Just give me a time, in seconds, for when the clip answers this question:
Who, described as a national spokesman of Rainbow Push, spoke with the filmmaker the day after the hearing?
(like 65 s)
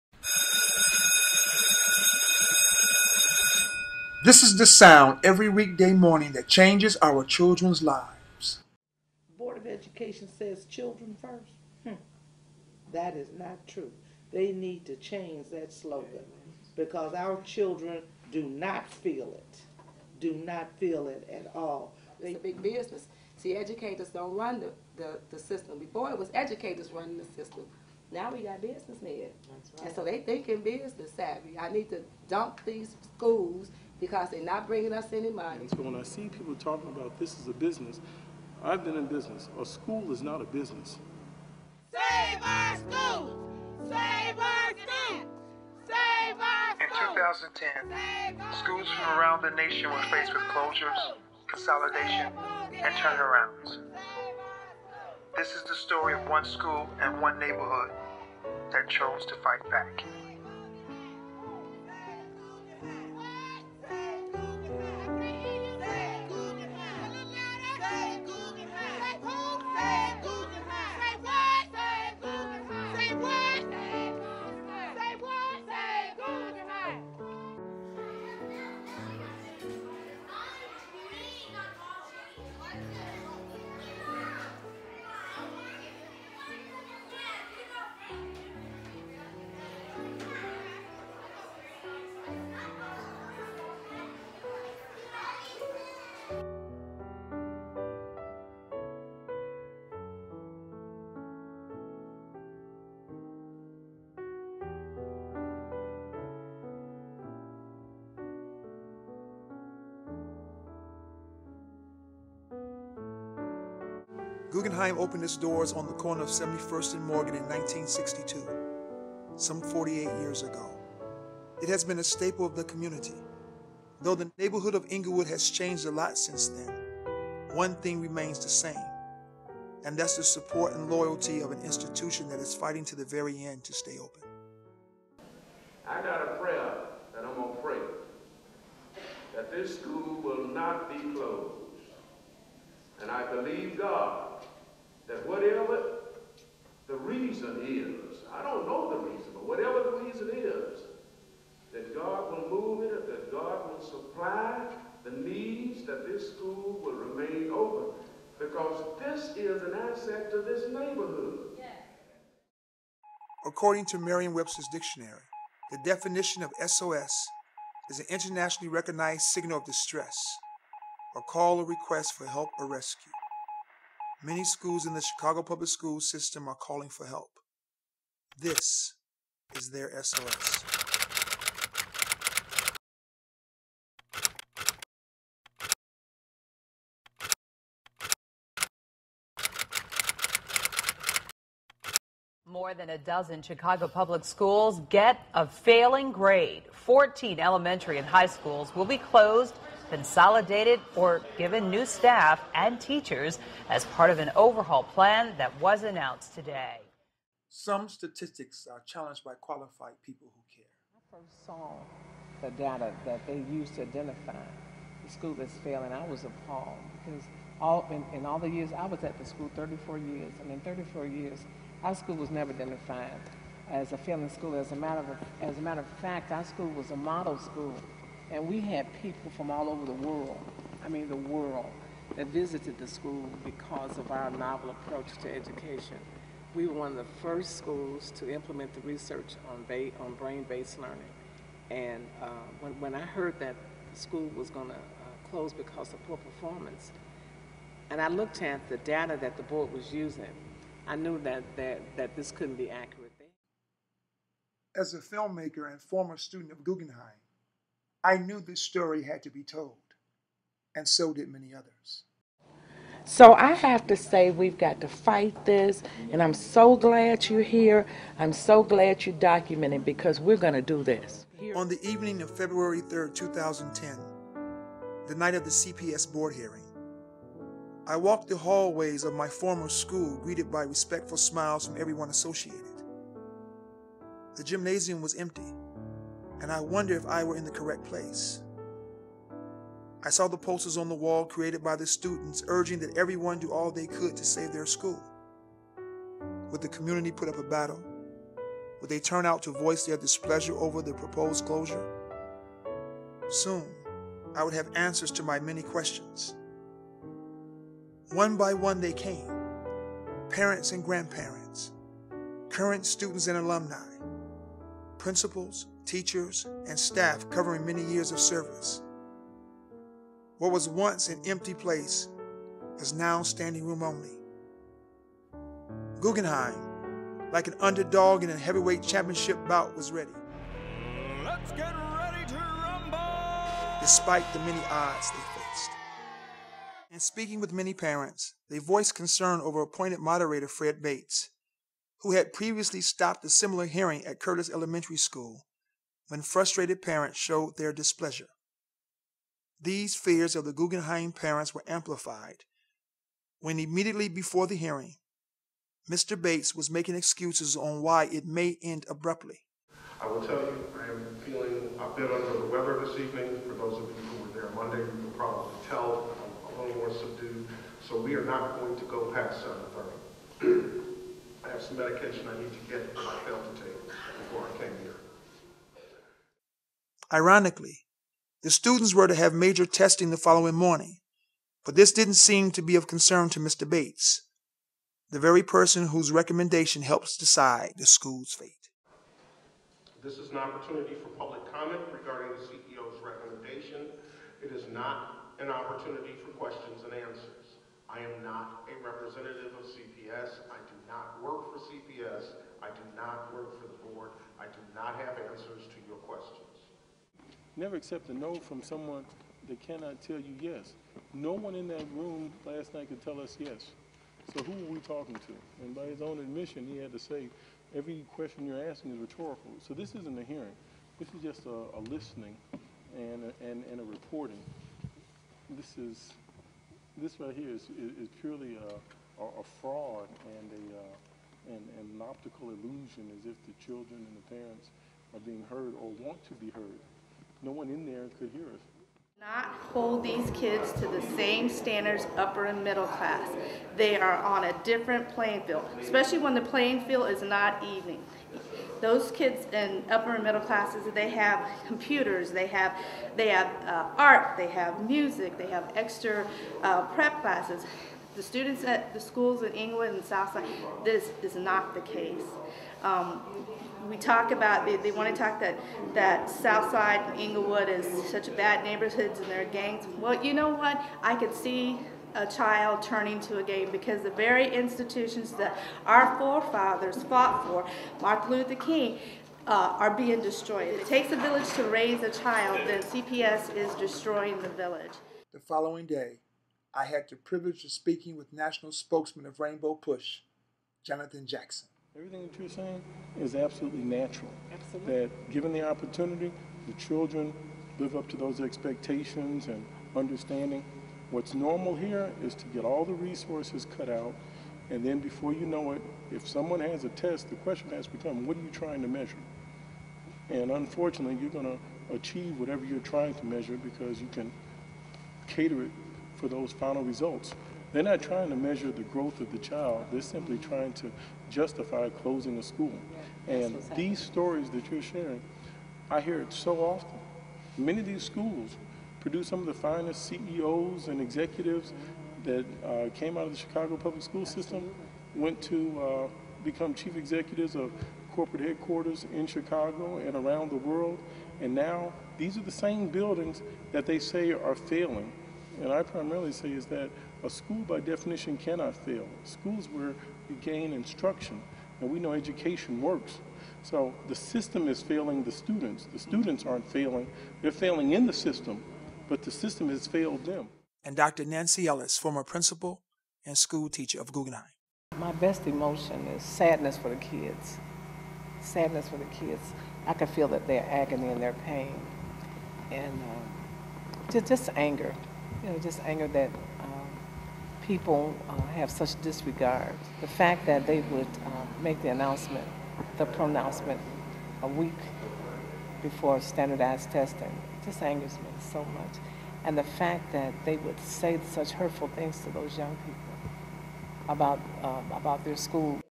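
490 s.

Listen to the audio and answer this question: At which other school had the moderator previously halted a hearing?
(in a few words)
Curtis Elementary School.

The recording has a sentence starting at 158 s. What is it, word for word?
Because this is an asset to this neighborhood.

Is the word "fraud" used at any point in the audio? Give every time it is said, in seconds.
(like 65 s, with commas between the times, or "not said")
429 s.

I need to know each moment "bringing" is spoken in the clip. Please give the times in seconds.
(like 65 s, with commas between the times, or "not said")
34 s.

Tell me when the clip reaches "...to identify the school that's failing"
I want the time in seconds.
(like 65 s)
213 s.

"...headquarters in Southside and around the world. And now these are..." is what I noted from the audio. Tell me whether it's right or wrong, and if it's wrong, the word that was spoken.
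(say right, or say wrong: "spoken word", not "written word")
wrong: "Chicago", not "Southside".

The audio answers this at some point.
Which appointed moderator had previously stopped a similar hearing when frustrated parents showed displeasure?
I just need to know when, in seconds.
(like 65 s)
340 s.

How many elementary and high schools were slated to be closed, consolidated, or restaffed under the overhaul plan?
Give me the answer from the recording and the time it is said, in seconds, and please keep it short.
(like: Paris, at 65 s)
14, at 196 s.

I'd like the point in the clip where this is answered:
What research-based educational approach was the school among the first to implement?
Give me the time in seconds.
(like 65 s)
240 s.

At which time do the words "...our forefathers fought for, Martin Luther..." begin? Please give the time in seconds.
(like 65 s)
475 s.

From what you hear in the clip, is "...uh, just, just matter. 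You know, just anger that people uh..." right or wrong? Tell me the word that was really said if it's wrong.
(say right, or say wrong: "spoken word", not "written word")
wrong: "anger", not "matter".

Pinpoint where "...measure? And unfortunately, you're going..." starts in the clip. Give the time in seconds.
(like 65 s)
508 s.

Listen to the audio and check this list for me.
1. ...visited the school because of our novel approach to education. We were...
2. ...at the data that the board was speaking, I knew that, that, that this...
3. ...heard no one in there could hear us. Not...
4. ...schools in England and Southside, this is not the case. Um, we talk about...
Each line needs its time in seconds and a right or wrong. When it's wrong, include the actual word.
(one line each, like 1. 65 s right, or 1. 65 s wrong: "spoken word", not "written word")
1. 232 s right
2. 248 s wrong: "using", not "speaking"
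3. 436 s right
4. 458 s right.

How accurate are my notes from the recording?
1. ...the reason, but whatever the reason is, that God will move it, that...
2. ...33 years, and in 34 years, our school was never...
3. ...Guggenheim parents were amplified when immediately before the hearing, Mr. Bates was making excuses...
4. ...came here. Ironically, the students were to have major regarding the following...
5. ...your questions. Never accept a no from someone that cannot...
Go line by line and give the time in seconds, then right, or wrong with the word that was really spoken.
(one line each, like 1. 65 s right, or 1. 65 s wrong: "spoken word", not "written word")
1. 148 s right
2. 219 s wrong: "34", not "33"
3. 350 s right
4. 374 s wrong: "testing", not "regarding"
5. 405 s right.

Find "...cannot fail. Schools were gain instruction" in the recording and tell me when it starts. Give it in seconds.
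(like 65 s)
548 s.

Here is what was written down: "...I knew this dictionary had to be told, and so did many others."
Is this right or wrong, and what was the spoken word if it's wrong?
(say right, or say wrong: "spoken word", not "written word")
wrong: "story", not "dictionary".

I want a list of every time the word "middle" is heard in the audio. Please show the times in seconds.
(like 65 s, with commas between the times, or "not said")
442 s, 450 s.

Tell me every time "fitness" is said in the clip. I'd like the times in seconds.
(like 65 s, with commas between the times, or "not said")
not said.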